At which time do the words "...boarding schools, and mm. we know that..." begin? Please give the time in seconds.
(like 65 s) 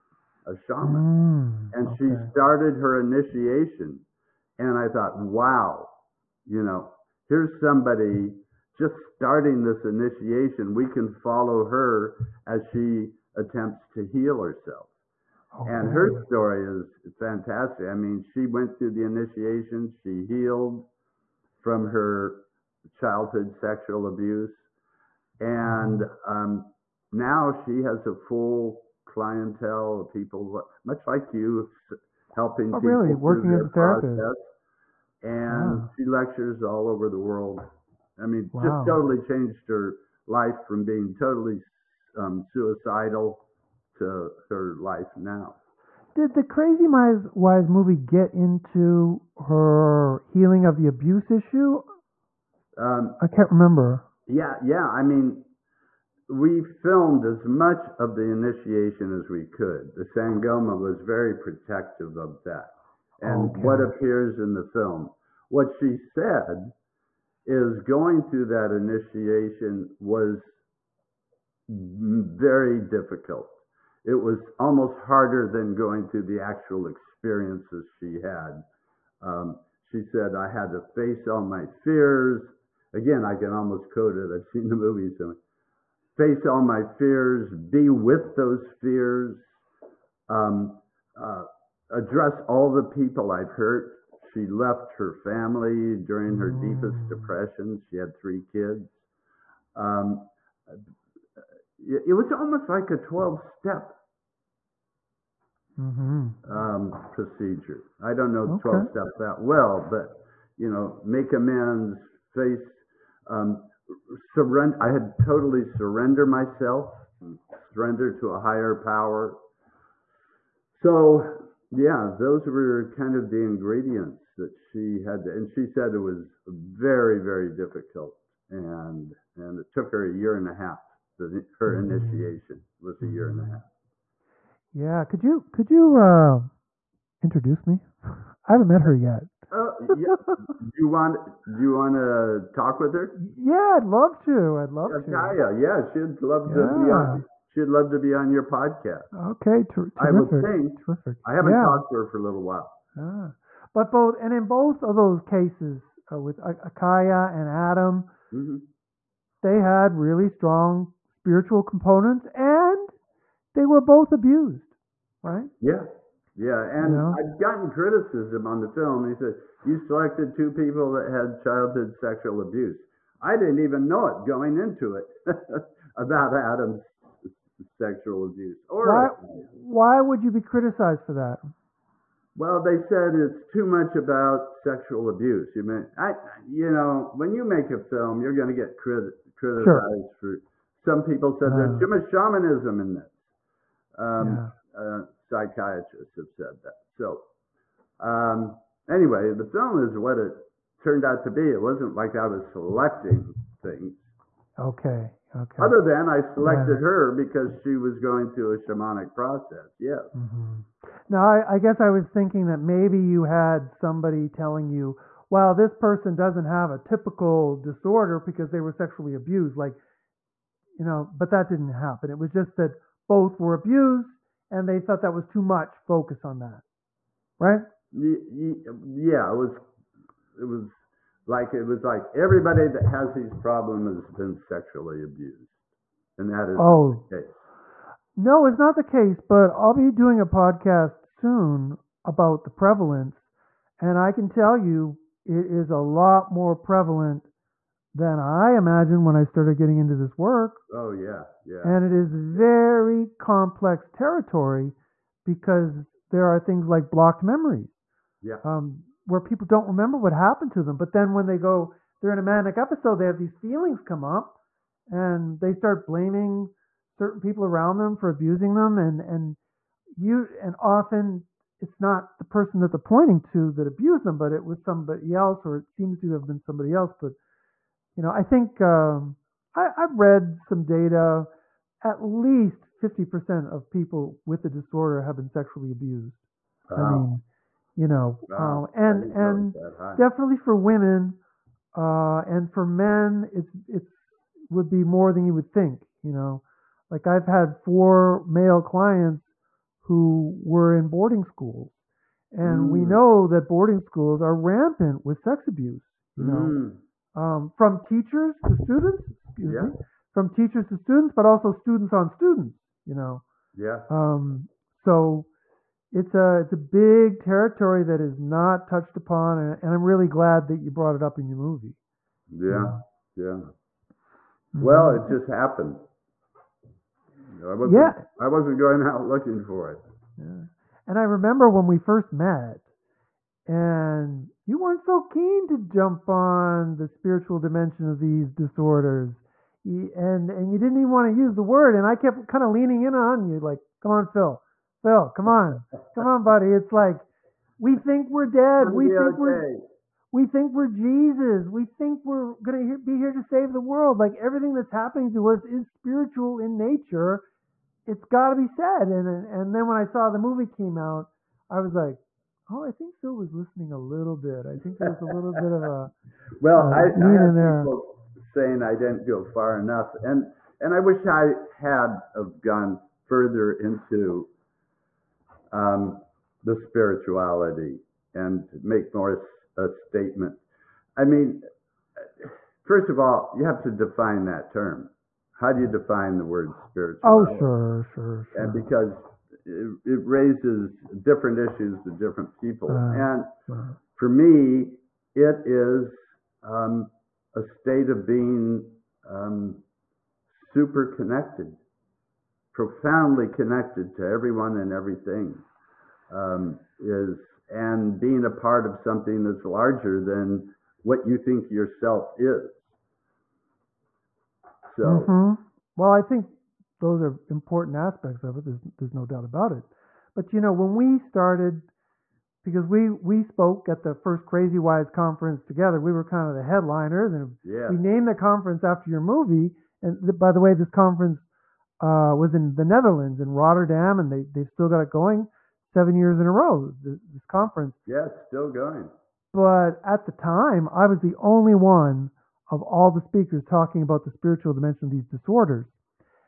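300 s.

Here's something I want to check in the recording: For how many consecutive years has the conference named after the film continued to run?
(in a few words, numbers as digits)
7.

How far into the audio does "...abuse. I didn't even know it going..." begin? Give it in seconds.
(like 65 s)
172 s.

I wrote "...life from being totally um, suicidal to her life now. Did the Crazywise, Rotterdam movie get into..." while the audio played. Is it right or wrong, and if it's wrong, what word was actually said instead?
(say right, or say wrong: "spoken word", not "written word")
wrong: "Wise", not "Rotterdam".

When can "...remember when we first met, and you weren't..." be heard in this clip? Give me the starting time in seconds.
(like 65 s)
331 s.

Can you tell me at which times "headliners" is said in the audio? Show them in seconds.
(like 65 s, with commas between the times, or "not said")
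426 s.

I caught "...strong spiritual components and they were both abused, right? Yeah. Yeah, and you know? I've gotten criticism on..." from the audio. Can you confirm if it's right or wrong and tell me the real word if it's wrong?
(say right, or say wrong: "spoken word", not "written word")
right.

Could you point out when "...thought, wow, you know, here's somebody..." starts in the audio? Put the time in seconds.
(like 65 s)
4 s.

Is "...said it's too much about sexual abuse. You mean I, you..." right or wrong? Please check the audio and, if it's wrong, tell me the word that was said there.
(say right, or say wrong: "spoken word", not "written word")
right.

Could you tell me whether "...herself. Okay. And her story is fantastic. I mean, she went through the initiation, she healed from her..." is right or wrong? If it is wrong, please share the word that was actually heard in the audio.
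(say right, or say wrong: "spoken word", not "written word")
right.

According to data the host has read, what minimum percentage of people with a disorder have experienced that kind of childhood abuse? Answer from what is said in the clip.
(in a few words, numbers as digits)
50%.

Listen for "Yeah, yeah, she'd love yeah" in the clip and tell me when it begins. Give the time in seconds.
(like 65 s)
145 s.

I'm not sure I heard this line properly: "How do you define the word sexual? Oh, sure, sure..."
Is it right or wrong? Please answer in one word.
wrong.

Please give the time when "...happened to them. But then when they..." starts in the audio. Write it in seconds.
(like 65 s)
260 s.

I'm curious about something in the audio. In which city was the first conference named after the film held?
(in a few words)
Rotterdam.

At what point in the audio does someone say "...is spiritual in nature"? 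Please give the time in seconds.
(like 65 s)
355 s.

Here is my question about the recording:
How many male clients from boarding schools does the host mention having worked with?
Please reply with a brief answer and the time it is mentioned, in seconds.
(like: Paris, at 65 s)
4, at 297 s.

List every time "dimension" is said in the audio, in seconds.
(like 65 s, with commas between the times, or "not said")
337 s, 444 s.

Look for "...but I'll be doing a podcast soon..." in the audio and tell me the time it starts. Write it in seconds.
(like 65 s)
239 s.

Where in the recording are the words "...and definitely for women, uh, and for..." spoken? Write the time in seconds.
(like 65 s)
289 s.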